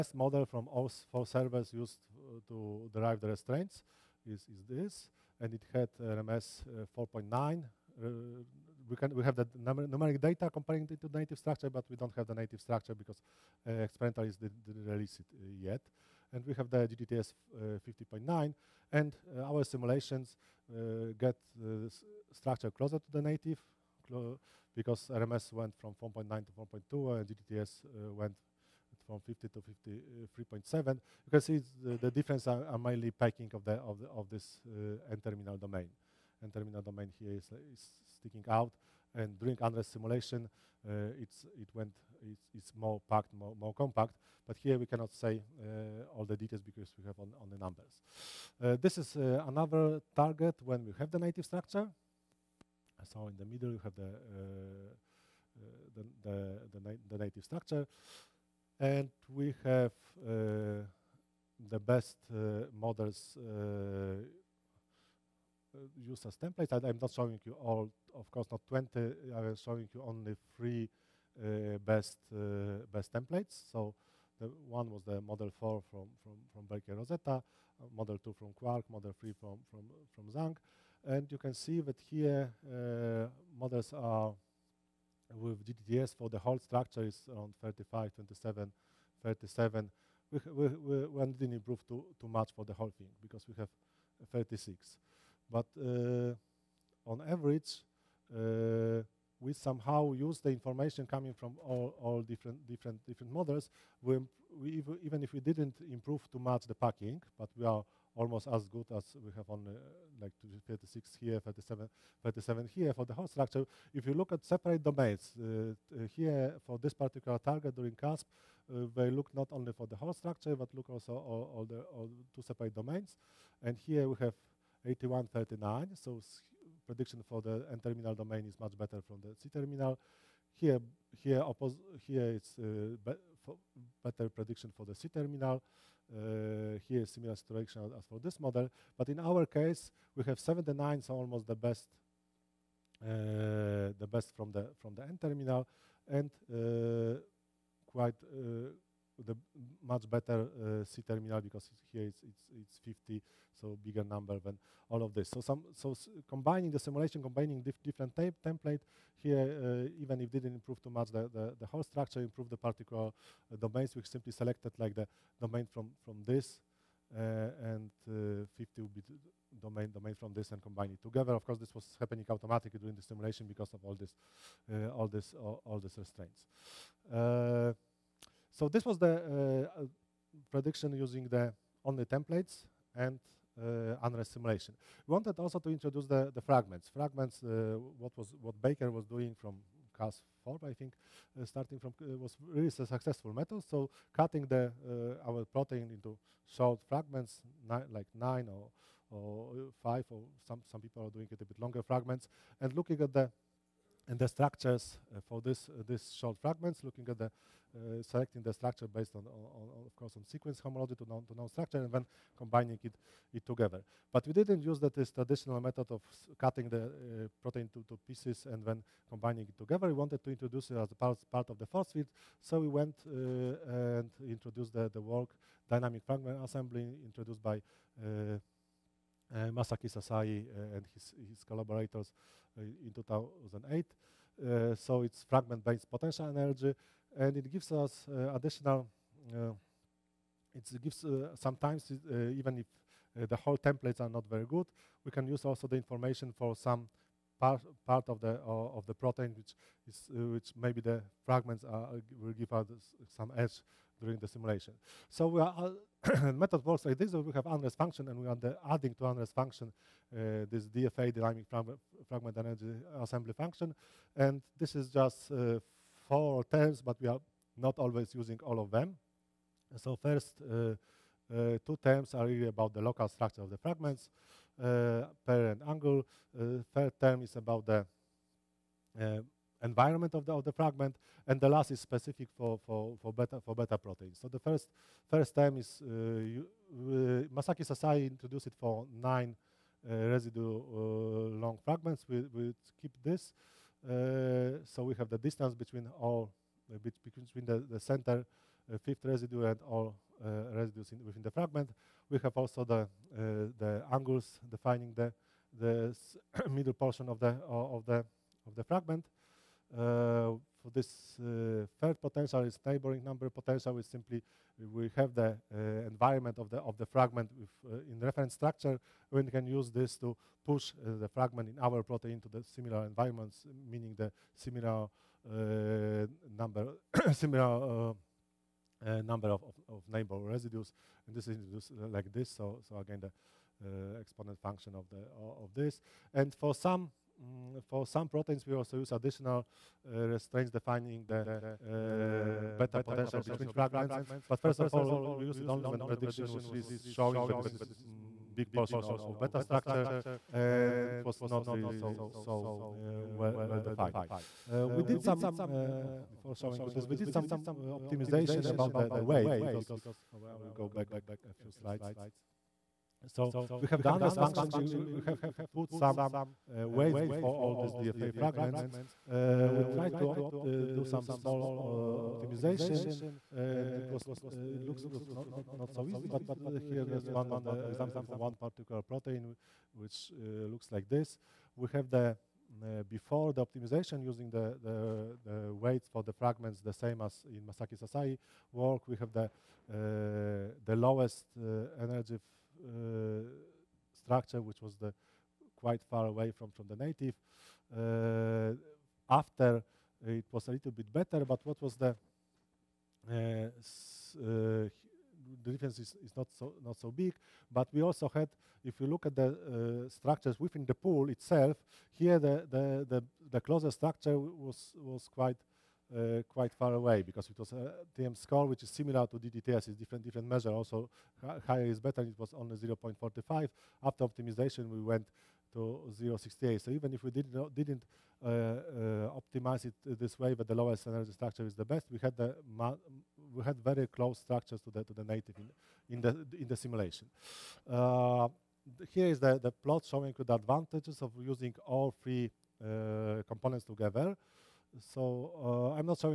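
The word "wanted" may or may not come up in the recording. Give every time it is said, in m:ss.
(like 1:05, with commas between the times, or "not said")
3:05, 3:39.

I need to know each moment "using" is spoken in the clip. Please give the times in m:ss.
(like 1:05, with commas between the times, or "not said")
3:00, 4:28, 6:24, 7:21.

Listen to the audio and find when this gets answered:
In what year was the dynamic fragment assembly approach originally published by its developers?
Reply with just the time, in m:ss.
3:52.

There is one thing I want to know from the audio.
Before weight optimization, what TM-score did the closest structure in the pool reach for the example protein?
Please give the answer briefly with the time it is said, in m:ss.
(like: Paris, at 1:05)
0.45, at 7:02.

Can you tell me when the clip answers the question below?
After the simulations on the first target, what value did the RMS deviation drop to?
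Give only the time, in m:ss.
0:26.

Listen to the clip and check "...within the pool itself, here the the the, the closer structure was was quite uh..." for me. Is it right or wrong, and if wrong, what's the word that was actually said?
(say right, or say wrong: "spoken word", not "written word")
right.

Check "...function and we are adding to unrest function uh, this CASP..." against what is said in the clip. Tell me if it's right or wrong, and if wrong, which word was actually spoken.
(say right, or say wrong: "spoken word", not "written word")
wrong: "DFA", not "CASP".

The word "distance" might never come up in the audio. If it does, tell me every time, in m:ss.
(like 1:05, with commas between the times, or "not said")
4:55.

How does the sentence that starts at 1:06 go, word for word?
I, am not showing you all, of course, not 20.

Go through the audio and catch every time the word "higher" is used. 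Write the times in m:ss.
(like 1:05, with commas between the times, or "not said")
7:01.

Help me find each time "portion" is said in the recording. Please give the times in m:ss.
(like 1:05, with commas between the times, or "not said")
5:06, 5:48.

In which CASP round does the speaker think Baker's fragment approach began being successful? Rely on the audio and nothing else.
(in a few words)
CASP 4.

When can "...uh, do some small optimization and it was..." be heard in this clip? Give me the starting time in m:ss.
6:10.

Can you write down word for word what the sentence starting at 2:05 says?
So prediction for the N-terminal domain is much better from the C-terminal.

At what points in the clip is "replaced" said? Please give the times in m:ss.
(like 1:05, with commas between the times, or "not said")
not said.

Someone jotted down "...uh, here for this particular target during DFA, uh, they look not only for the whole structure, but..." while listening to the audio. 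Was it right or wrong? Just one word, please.
wrong.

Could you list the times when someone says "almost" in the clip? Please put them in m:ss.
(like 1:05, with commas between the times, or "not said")
1:48, 2:21.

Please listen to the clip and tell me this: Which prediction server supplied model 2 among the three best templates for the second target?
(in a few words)
Quark.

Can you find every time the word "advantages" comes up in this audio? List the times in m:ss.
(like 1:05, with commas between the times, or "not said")
7:20.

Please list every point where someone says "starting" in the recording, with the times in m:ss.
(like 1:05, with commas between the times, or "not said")
3:11.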